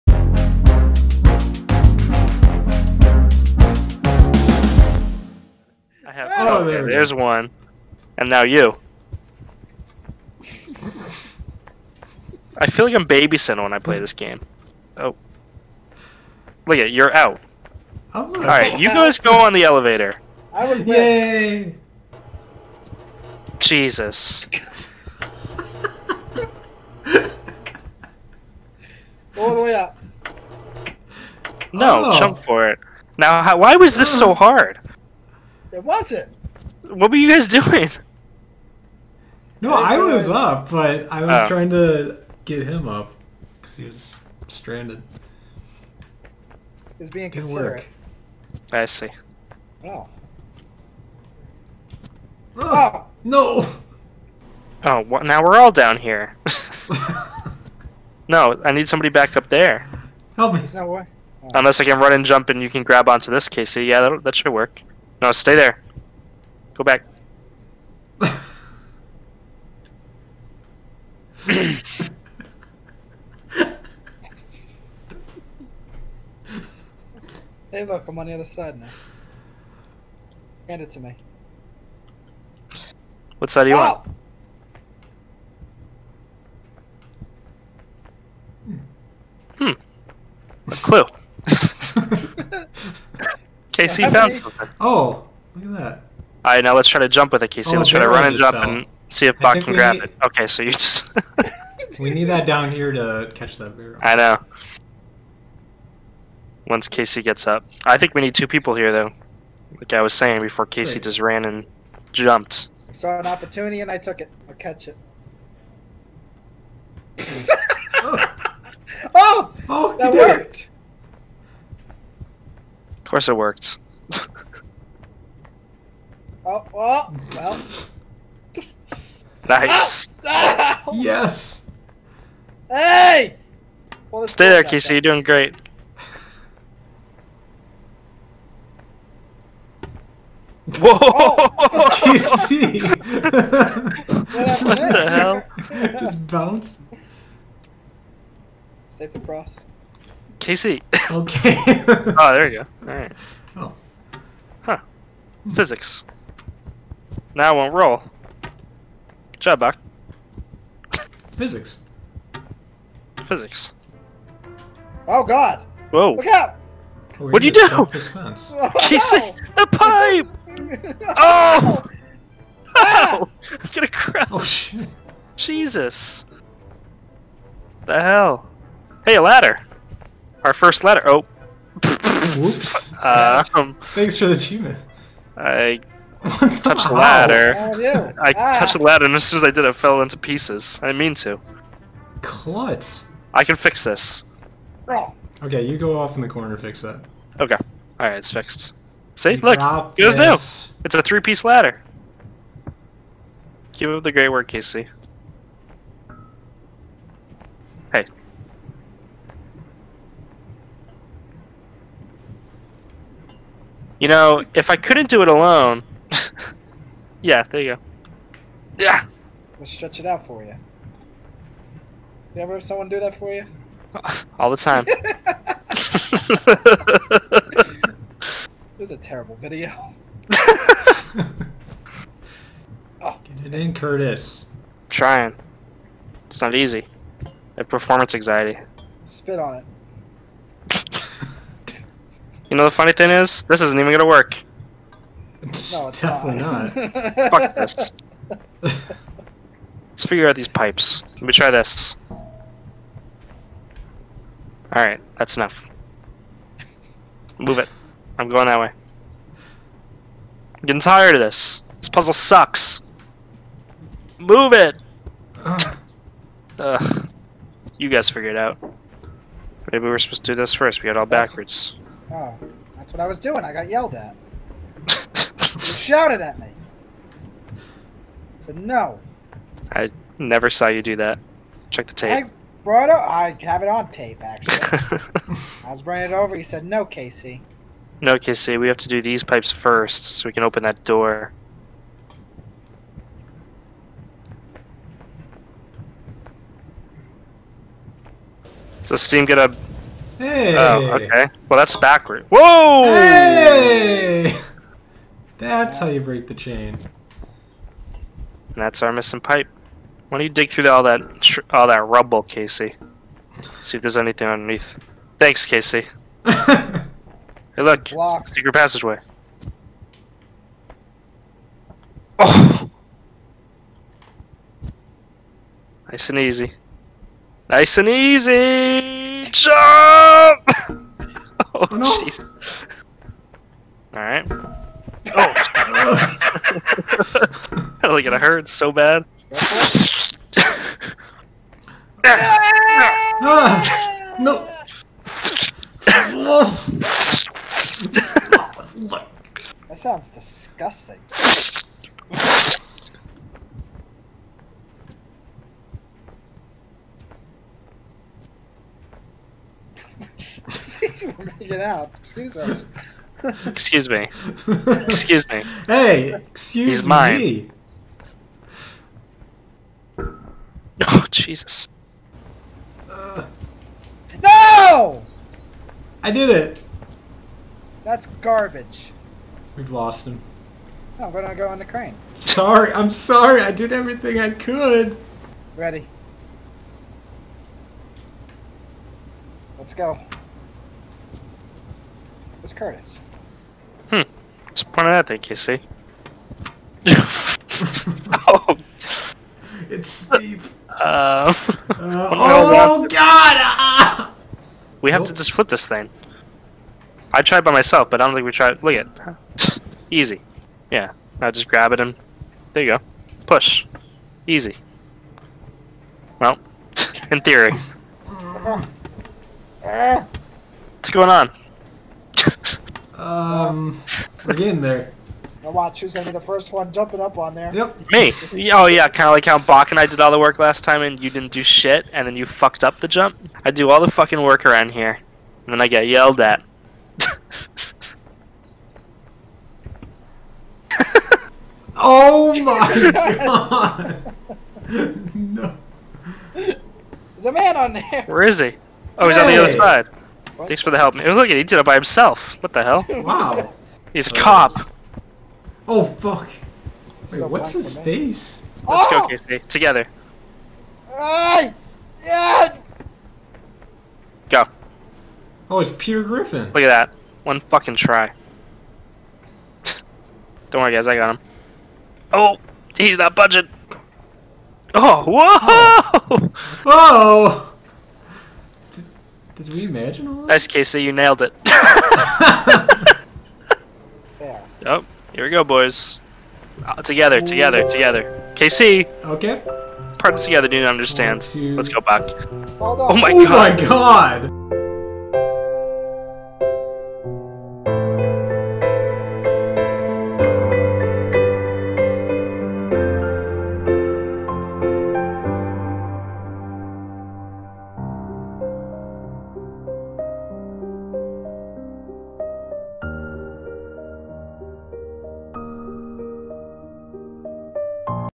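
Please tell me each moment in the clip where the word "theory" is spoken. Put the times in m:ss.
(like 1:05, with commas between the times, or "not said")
6:57.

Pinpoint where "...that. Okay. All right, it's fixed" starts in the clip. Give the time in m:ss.
3:16.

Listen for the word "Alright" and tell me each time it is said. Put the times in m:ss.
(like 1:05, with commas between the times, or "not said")
0:18, 4:14.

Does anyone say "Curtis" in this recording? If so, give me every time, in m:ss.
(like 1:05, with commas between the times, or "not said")
3:53, 6:32.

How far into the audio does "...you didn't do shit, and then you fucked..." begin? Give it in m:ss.
7:11.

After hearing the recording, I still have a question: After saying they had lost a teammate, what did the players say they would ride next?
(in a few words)
The crane.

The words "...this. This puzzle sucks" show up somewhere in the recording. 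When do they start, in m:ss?
4:21.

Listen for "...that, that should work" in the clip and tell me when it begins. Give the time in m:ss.
1:04.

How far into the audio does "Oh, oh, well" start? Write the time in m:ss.
2:06.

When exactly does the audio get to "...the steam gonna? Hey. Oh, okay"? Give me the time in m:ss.
4:58.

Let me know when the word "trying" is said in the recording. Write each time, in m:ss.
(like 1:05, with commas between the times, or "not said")
0:41, 3:54.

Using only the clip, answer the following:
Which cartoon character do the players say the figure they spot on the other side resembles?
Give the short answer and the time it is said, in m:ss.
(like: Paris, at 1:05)
Peter Griffin, at 7:45.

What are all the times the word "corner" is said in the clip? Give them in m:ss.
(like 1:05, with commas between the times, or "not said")
3:16.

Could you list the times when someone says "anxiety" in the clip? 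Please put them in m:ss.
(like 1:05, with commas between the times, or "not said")
3:58.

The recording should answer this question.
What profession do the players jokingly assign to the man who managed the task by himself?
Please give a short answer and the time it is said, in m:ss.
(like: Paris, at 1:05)
Cop, at 7:34.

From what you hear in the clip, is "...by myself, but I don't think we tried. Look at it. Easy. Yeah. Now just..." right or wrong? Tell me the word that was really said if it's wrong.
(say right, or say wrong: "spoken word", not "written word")
right.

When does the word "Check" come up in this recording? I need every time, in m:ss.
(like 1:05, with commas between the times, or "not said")
4:41.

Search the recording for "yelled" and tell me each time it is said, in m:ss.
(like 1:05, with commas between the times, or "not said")
4:33, 7:15.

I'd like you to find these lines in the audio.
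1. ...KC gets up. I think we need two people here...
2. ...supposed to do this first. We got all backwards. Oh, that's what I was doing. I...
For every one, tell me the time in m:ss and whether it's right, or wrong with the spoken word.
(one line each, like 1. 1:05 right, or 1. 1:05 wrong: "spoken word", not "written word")
1. 1:46 right
2. 4:29 right.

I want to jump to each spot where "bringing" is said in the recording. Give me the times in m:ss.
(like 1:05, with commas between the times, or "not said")
4:45.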